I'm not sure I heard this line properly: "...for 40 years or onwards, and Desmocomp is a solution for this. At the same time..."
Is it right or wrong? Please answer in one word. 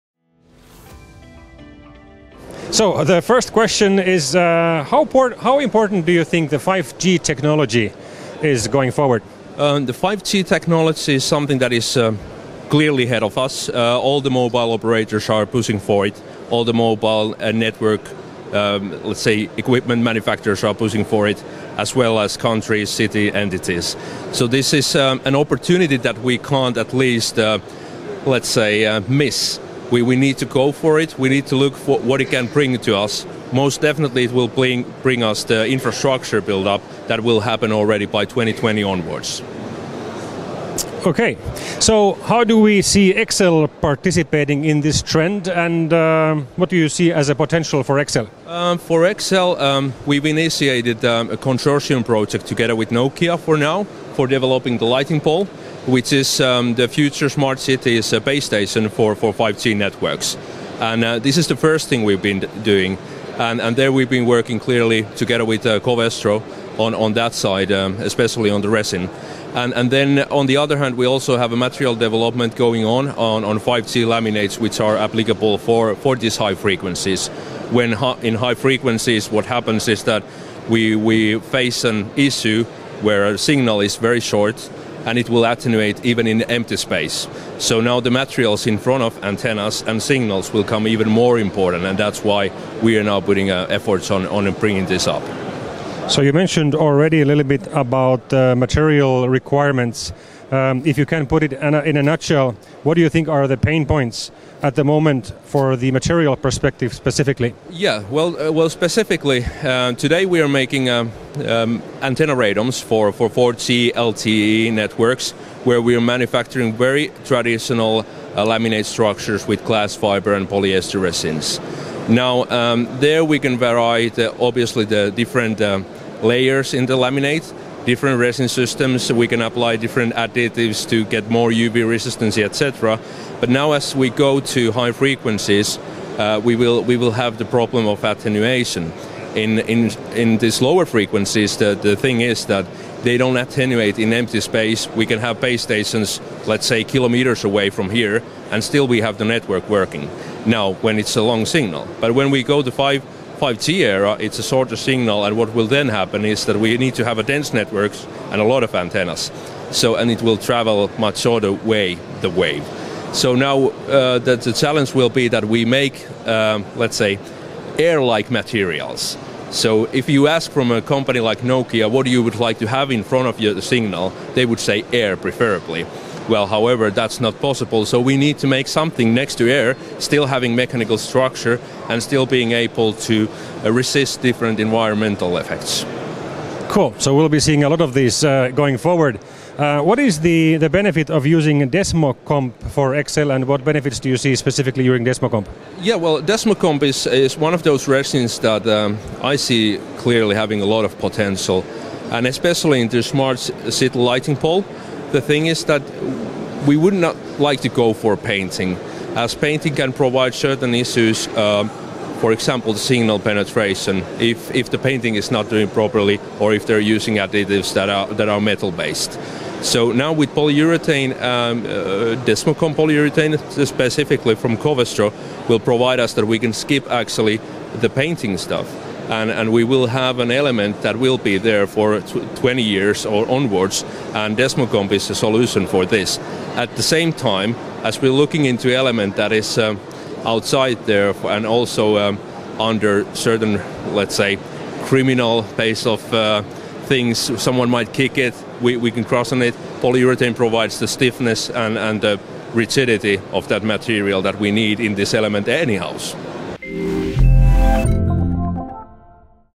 wrong.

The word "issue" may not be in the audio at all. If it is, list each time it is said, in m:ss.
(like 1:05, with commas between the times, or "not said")
1:22, 3:30.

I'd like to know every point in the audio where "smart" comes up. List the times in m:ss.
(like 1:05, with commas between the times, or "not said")
0:57, 3:23.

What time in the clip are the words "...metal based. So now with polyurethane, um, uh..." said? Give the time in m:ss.
3:38.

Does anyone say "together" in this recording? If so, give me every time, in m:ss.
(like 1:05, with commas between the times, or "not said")
0:52, 1:05.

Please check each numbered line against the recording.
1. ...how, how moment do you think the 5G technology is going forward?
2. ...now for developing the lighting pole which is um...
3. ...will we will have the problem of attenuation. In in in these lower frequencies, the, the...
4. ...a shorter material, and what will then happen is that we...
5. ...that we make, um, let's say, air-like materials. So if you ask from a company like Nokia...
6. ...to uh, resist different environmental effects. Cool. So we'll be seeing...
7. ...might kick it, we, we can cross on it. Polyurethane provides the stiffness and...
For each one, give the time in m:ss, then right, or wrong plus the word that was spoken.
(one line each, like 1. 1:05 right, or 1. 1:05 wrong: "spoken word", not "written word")
1. 0:04 wrong: "important", not "moment"
2. 0:53 right
3. 2:16 right
4. 2:34 wrong: "signal", not "material"
5. 2:45 right
6. 3:03 right
7. 4:07 right.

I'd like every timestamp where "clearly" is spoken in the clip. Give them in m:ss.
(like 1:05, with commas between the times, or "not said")
0:12, 1:04, 3:19.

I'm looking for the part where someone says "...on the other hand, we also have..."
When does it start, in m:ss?
1:10.